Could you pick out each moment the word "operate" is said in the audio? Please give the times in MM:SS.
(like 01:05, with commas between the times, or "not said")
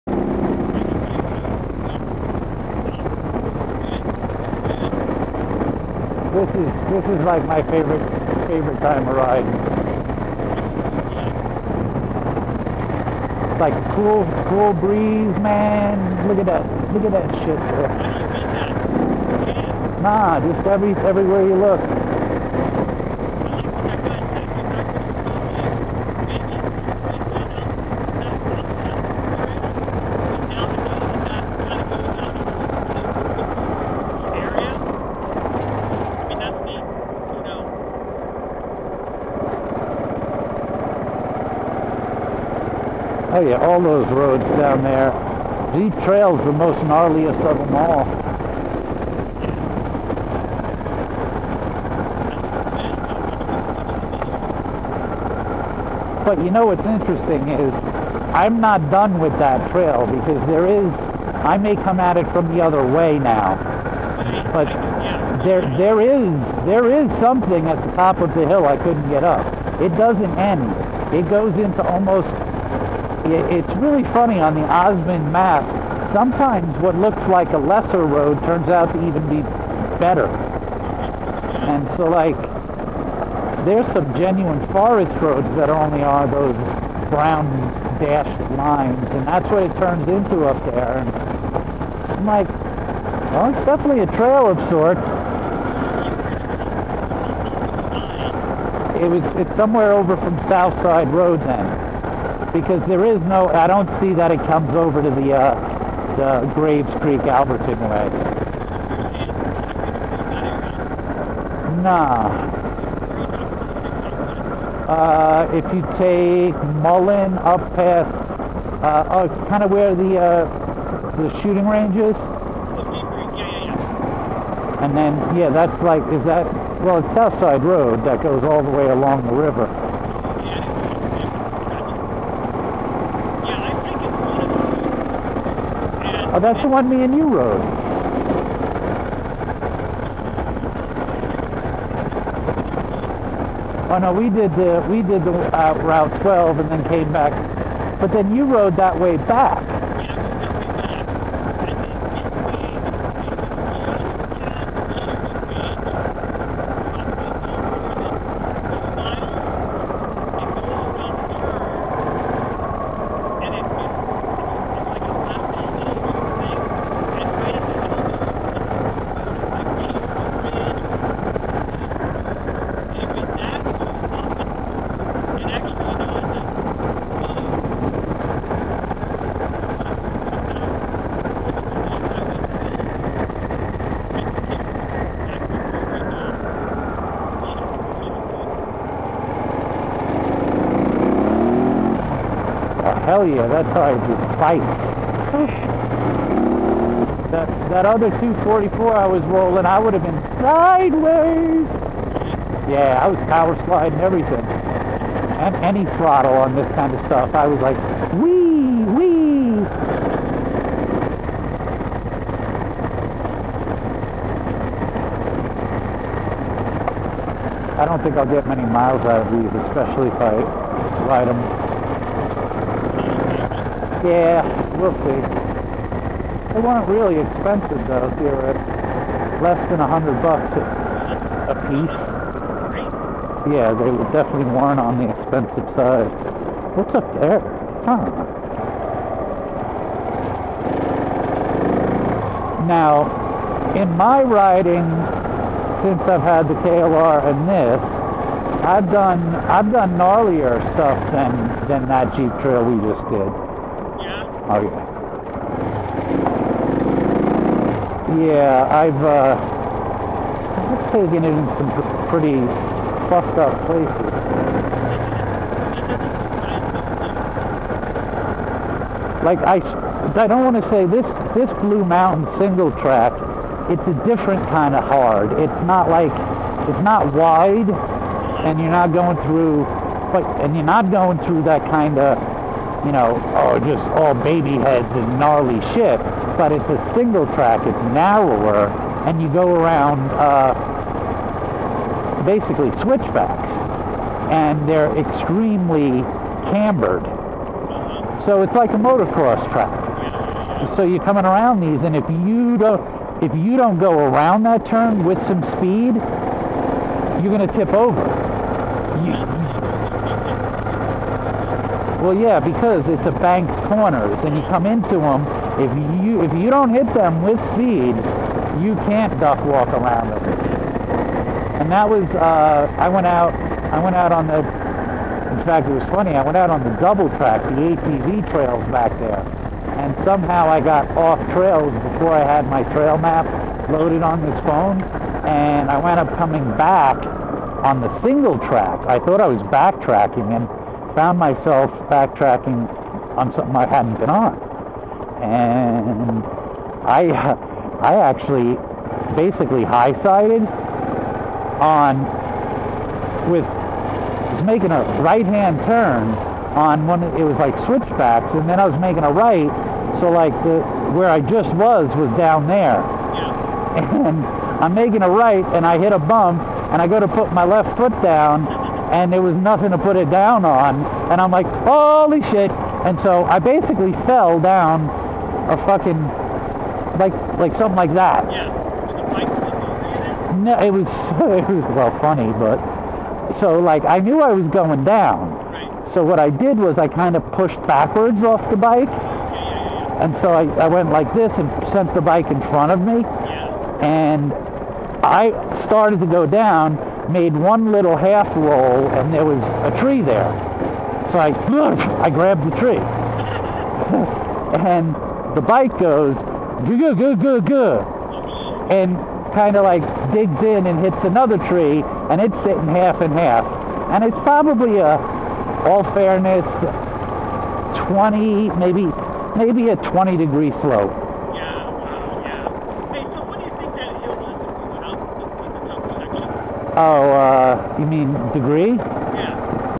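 not said.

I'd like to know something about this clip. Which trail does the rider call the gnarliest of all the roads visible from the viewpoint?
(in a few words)
Deep Trail.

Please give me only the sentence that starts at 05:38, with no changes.
I thought I was backtracking and found myself backtracking on something I hadn't been on.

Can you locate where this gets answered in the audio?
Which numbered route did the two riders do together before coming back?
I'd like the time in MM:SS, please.
02:25.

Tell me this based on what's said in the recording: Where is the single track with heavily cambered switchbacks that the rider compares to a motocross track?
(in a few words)
Blue Mountain.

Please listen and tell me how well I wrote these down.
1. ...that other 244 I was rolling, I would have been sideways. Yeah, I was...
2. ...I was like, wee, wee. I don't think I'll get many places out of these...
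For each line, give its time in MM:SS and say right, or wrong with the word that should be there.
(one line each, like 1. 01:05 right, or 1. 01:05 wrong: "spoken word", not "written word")
1. 03:17 right
2. 03:27 wrong: "miles", not "places".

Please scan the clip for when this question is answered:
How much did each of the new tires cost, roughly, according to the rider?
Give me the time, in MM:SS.
03:49.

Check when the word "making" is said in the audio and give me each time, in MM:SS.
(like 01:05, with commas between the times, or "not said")
05:54, 05:58, 06:04.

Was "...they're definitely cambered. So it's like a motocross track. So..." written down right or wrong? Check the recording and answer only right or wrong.
wrong.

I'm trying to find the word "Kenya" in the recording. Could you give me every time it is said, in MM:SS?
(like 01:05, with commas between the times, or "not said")
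not said.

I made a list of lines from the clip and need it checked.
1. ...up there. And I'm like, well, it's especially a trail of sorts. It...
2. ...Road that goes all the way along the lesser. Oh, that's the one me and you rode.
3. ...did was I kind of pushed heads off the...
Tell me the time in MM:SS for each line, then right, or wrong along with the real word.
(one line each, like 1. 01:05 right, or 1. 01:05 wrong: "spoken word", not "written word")
1. 01:30 wrong: "definitely", not "especially"
2. 02:07 wrong: "river", not "lesser"
3. 06:26 wrong: "backwards", not "heads".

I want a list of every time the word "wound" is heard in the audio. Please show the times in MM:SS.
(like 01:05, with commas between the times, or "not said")
05:35.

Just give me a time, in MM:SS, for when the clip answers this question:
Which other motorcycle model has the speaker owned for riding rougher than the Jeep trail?
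04:06.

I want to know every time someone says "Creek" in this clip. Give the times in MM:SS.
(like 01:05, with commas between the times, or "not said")
01:47.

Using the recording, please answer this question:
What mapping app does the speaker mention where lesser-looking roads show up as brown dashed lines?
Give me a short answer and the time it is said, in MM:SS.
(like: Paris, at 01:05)
OsmAnd, at 01:14.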